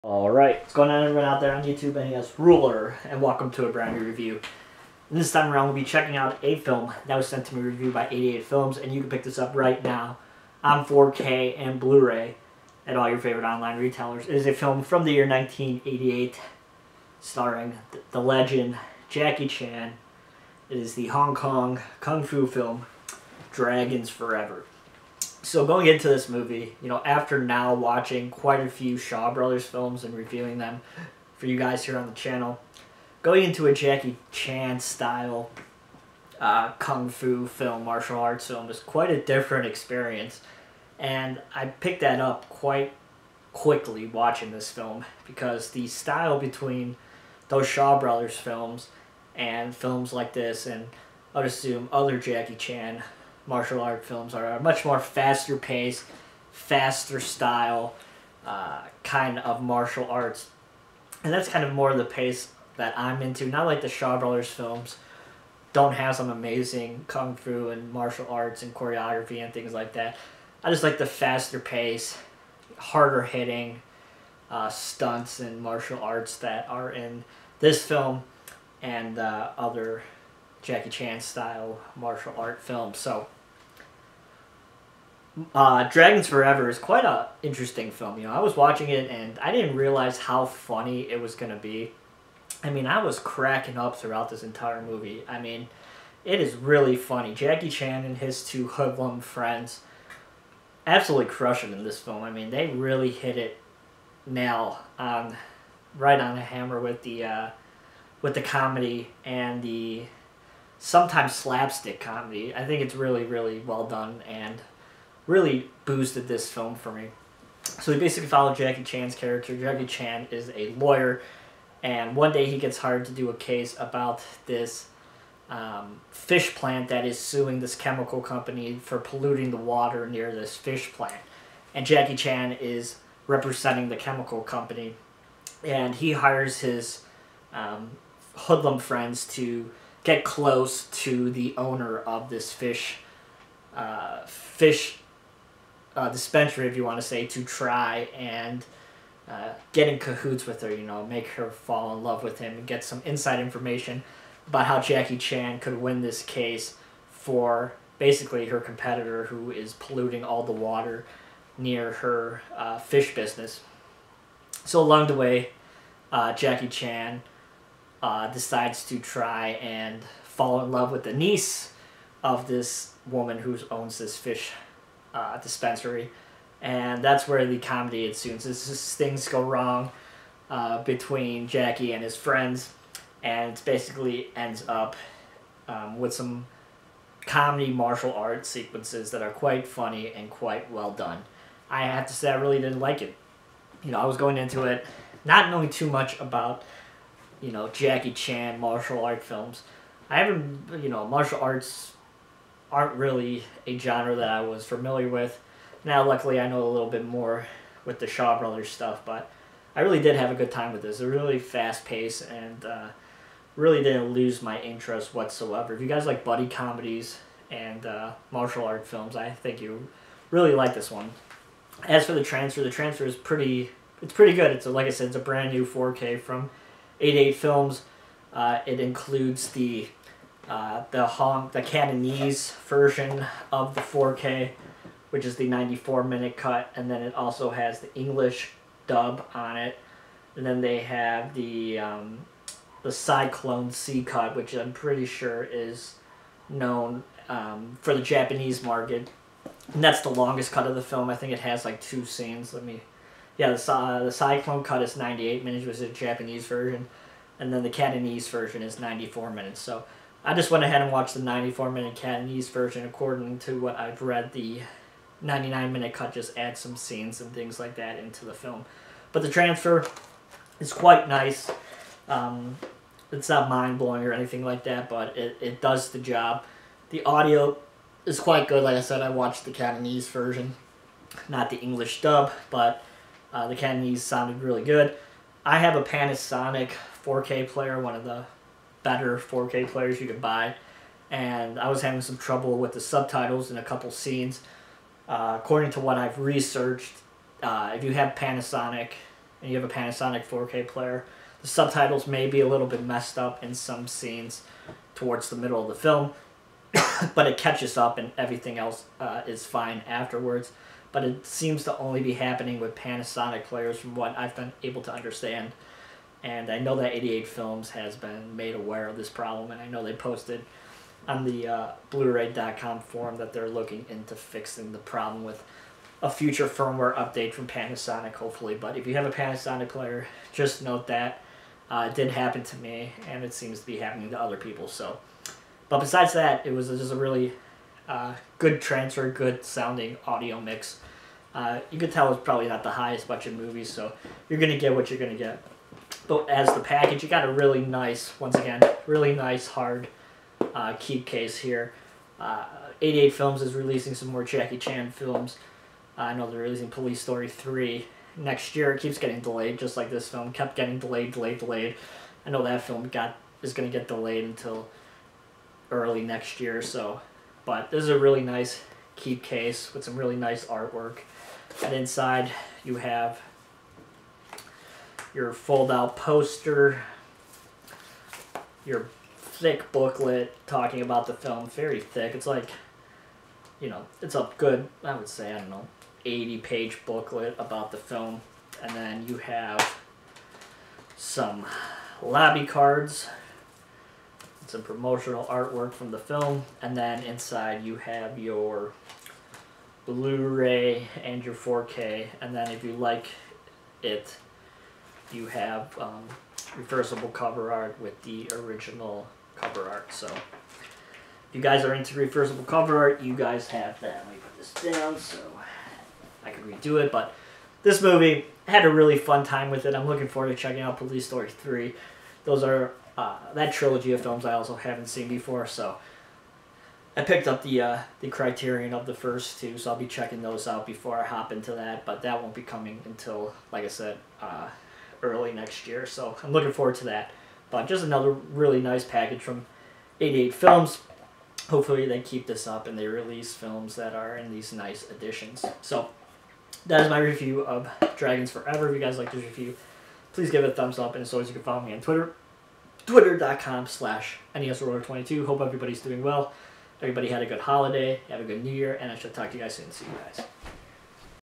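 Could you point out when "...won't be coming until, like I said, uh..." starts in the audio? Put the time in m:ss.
7:12.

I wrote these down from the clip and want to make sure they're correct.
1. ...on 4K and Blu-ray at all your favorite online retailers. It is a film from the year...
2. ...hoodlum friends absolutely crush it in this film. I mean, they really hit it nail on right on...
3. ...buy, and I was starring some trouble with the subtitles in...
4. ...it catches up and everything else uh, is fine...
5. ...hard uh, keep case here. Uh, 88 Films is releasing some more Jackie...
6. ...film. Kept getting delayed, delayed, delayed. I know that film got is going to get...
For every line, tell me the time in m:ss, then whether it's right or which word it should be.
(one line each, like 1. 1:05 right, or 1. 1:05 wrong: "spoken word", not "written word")
1. 0:10 right
2. 1:38 right
3. 4:50 wrong: "having", not "starring"
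4. 5:07 right
5. 5:49 right
6. 6:00 right.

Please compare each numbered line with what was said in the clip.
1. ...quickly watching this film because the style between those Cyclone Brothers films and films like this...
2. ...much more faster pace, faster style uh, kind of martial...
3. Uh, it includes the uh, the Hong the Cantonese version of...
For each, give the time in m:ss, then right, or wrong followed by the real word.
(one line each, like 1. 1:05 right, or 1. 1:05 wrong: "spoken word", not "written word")
1. 0:43 wrong: "Shaw", not "Cyclone"
2. 0:54 right
3. 3:48 right.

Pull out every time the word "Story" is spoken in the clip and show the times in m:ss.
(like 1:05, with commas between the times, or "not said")
5:57, 7:01.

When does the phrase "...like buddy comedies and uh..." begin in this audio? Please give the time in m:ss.
3:36.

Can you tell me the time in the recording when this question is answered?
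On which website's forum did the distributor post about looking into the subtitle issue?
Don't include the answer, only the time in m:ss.
5:21.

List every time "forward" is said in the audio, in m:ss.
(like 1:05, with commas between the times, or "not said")
7:00, 7:16.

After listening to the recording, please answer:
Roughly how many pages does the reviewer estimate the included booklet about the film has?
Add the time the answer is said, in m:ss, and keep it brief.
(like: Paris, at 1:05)
80, at 6:26.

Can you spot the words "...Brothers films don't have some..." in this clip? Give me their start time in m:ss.
1:04.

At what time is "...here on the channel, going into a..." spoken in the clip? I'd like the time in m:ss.
0:31.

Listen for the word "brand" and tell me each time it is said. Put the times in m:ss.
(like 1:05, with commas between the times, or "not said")
0:03, 3:45.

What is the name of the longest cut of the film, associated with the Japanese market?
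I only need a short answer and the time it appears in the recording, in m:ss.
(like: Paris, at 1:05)
Cyclone Z, at 4:02.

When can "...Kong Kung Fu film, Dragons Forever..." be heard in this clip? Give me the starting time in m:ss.
0:21.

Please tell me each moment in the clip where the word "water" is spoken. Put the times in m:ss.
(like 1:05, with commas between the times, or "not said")
2:09, 2:40.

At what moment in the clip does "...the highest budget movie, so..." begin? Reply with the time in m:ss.
5:42.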